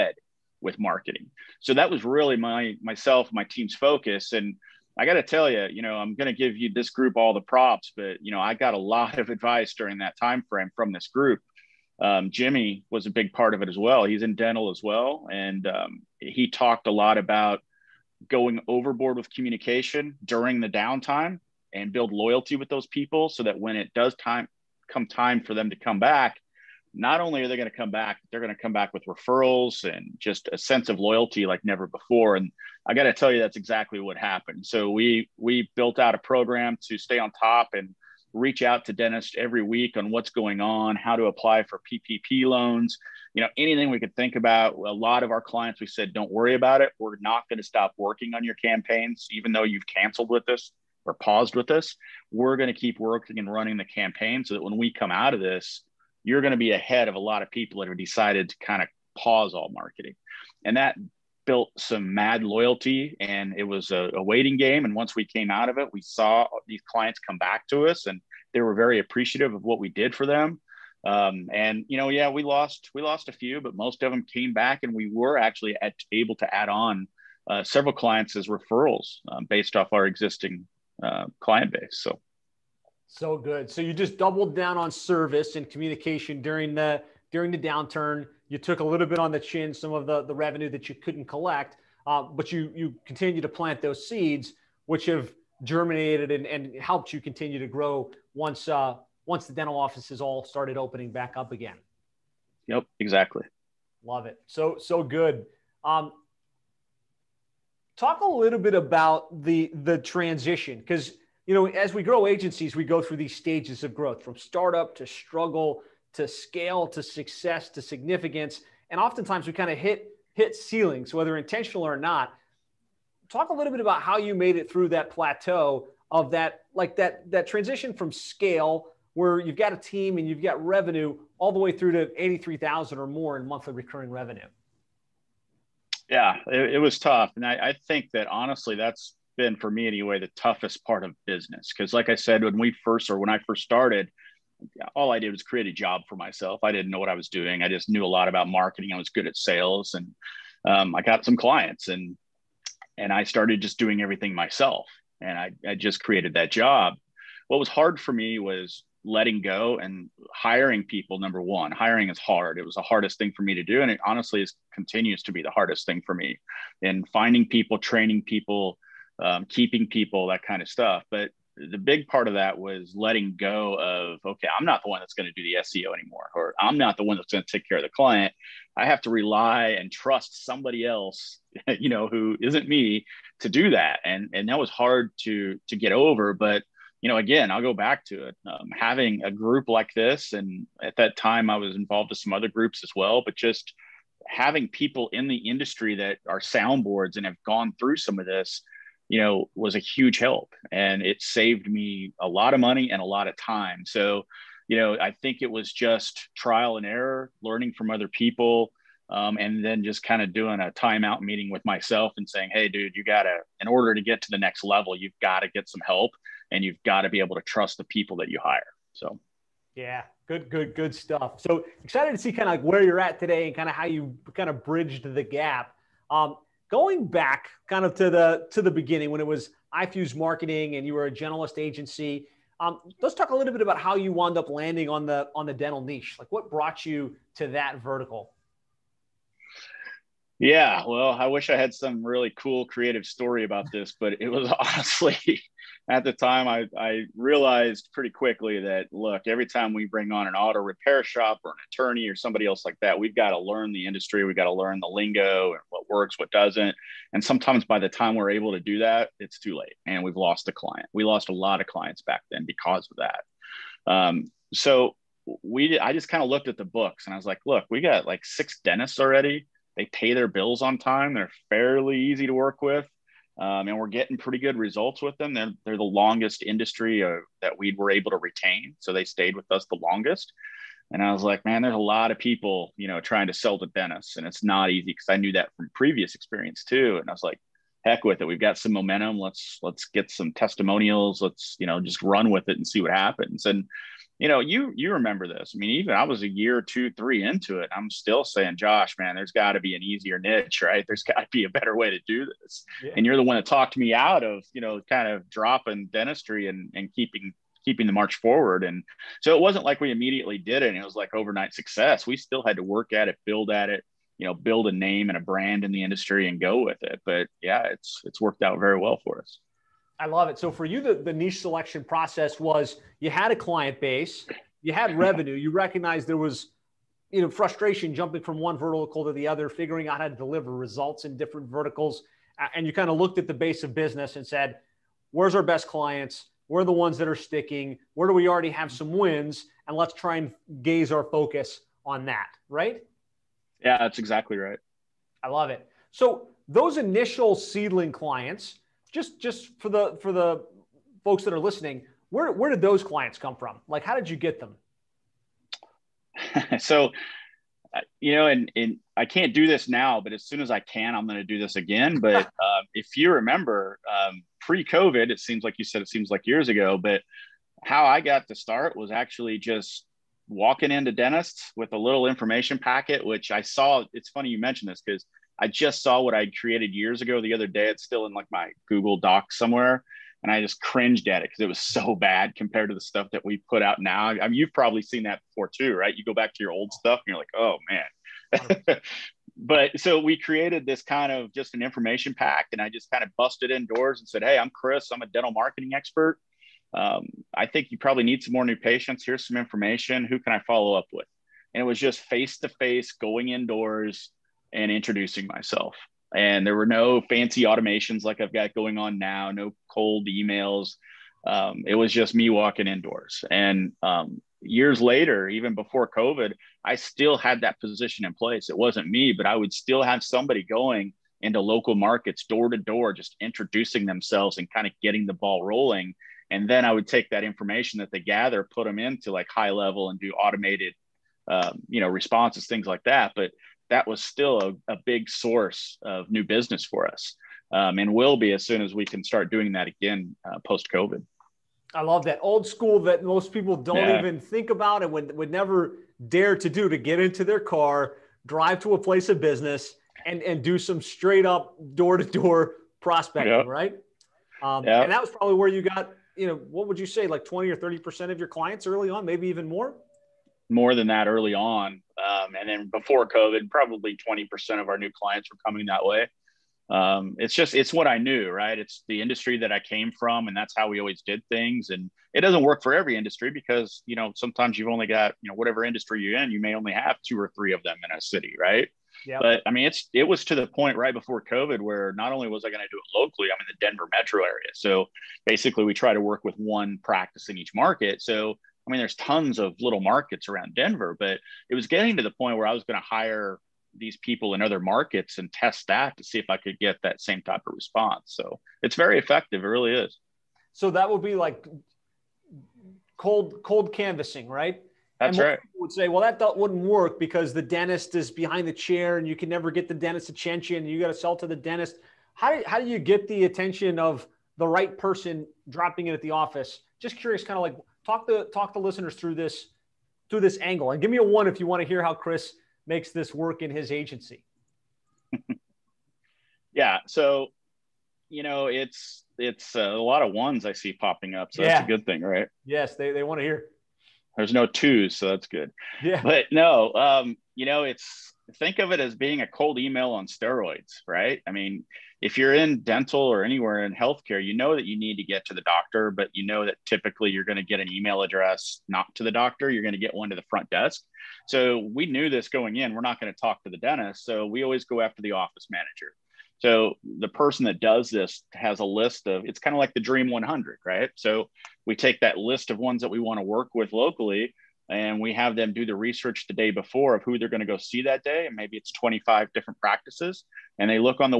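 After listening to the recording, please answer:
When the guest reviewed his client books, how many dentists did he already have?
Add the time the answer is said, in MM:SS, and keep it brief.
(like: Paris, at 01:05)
6, at 04:28.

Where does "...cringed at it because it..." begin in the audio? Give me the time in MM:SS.
06:20.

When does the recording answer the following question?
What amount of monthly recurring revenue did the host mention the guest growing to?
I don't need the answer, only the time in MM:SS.
02:12.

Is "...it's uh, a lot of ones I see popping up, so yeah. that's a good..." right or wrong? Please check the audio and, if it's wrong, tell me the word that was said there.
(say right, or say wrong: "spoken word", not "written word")
right.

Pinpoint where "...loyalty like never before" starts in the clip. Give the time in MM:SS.
00:30.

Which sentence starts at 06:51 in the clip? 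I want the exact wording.
Um, it was just me walking indoors.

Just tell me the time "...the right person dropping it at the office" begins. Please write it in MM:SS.
08:34.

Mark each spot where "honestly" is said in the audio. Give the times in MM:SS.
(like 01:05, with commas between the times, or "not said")
02:18, 02:44, 04:04.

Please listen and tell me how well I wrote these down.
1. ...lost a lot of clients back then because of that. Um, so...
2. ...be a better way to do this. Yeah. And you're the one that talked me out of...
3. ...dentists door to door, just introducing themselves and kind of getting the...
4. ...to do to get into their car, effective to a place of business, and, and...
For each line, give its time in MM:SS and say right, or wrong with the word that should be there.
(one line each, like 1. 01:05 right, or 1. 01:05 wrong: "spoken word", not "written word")
1. 04:21 right
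2. 05:01 right
3. 07:01 wrong: "markets", not "dentists"
4. 07:26 wrong: "drive", not "effective".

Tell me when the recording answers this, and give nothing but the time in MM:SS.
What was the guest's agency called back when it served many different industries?
03:49.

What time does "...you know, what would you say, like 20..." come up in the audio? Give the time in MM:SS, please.
07:36.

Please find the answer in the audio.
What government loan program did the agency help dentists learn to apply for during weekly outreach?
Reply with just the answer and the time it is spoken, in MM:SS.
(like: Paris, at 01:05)
PPP loans, at 00:41.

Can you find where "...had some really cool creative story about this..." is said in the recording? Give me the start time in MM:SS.
04:01.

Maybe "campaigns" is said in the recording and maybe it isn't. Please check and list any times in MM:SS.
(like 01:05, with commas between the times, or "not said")
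00:48, 00:53.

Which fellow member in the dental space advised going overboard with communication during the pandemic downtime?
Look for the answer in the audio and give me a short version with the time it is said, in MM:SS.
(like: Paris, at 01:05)
Jimmy, at 00:12.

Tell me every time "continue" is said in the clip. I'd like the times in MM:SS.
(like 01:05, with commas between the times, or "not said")
01:33, 01:37, 02:44.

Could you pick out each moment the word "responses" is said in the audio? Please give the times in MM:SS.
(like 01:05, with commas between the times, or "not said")
07:11, 08:17.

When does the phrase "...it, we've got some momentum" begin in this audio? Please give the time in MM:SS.
04:48.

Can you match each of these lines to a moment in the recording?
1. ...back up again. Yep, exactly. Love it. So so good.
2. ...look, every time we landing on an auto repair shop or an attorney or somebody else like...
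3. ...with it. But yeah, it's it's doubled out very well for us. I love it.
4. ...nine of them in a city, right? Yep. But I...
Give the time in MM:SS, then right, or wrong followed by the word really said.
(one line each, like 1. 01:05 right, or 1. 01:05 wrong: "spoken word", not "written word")
1. 01:41 right
2. 04:08 wrong: "bring", not "landing"
3. 05:16 wrong: "worked", not "doubled"
4. 07:57 wrong: "three", not "nine".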